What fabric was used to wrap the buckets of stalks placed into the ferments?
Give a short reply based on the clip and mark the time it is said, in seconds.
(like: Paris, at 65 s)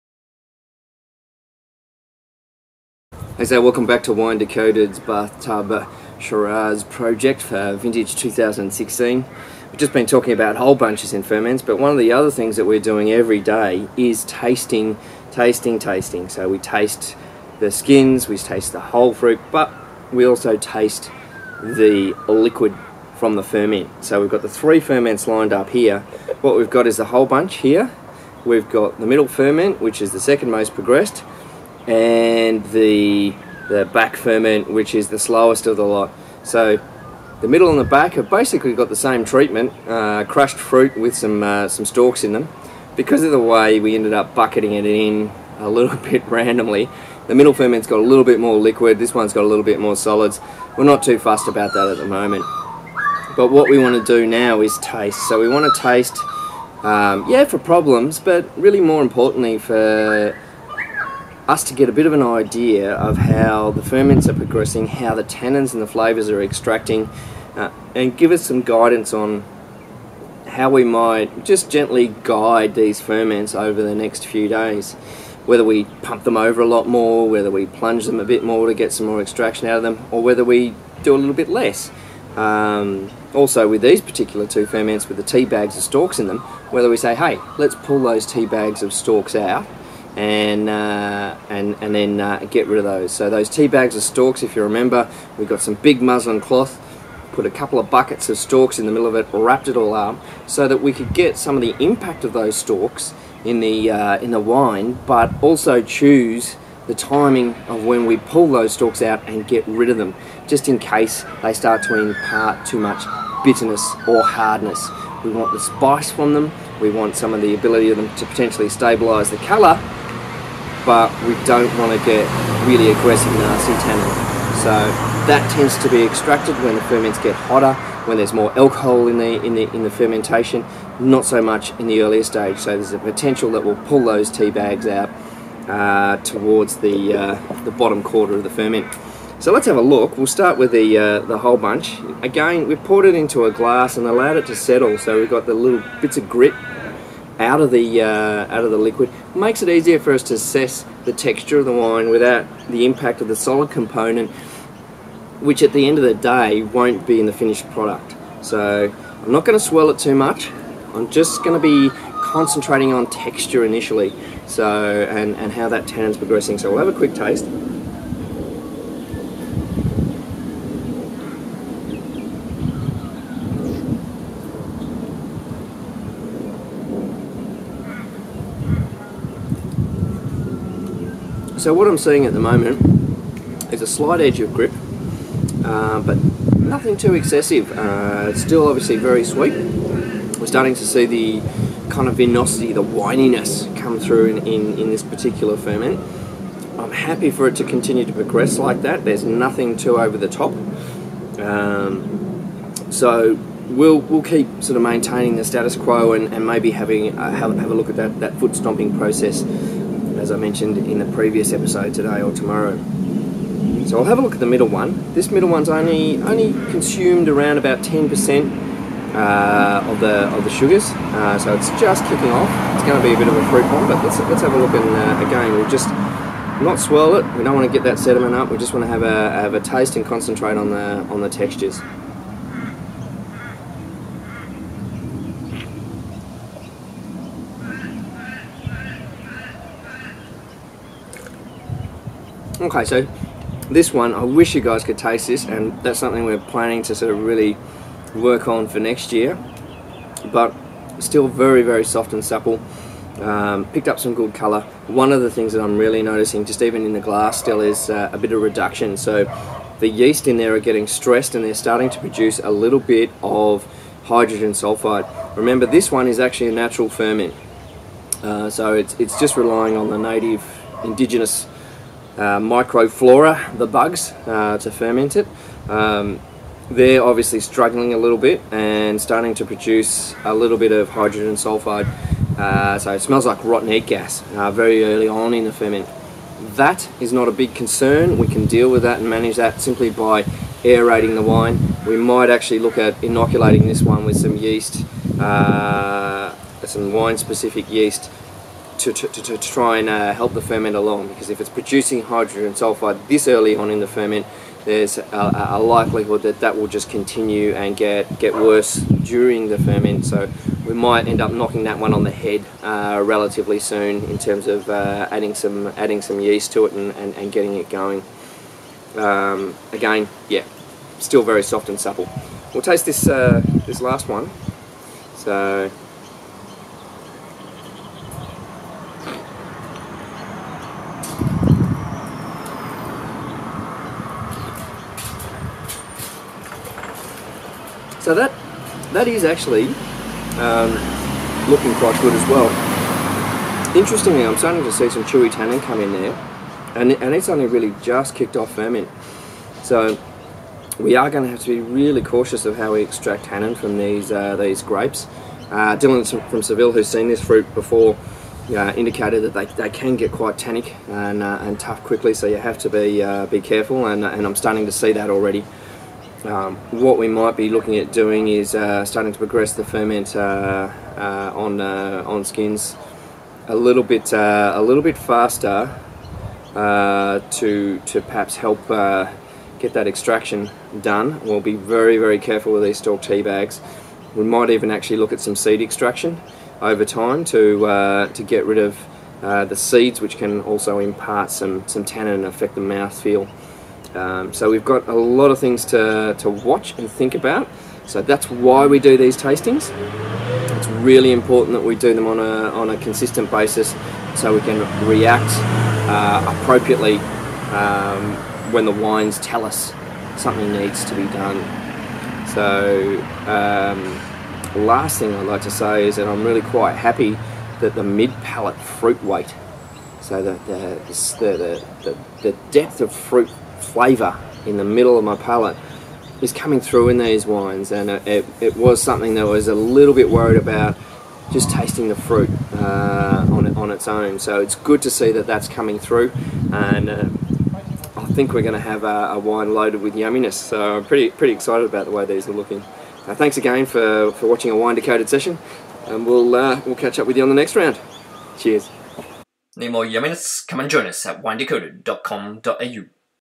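muslin cloth, at 96 s.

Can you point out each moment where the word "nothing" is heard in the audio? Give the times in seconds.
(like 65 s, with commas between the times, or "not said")
186 s, 199 s.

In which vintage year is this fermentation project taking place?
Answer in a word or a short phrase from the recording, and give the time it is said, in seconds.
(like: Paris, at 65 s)
2016, at 8 s.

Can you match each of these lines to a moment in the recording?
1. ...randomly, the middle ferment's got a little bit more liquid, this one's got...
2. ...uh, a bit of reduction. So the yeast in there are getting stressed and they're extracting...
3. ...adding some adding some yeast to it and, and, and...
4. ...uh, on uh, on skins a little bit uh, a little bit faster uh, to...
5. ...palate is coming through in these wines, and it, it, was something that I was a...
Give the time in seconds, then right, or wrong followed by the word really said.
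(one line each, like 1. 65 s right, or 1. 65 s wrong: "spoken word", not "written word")
1. 46 s right
2. 257 s wrong: "starting", not "extracting"
3. 315 s right
4. 370 s right
5. 425 s right.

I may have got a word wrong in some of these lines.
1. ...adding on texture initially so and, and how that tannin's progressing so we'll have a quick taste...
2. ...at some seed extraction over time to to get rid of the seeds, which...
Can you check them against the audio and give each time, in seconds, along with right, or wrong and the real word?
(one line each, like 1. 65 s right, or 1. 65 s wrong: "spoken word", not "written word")
1. 162 s wrong: "concentrating", not "adding"
2. 385 s right.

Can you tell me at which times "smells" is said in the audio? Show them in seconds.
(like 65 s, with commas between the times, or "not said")
282 s.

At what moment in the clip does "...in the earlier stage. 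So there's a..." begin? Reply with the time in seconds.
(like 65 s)
131 s.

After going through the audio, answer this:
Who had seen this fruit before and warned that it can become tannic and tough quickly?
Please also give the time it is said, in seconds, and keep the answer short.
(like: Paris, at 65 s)
Dylan, at 355 s.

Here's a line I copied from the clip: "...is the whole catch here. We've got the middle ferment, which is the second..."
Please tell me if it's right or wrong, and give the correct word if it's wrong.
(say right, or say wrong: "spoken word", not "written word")
wrong: "bunch", not "catch".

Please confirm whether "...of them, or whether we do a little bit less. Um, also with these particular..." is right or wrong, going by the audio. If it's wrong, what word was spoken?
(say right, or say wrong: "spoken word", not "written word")
right.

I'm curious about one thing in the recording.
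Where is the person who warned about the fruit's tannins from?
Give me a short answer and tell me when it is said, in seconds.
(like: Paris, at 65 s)
Seville, at 356 s.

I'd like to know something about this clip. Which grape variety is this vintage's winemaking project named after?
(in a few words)
Shiraz.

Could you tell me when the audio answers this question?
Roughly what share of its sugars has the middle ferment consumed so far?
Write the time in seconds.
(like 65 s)
217 s.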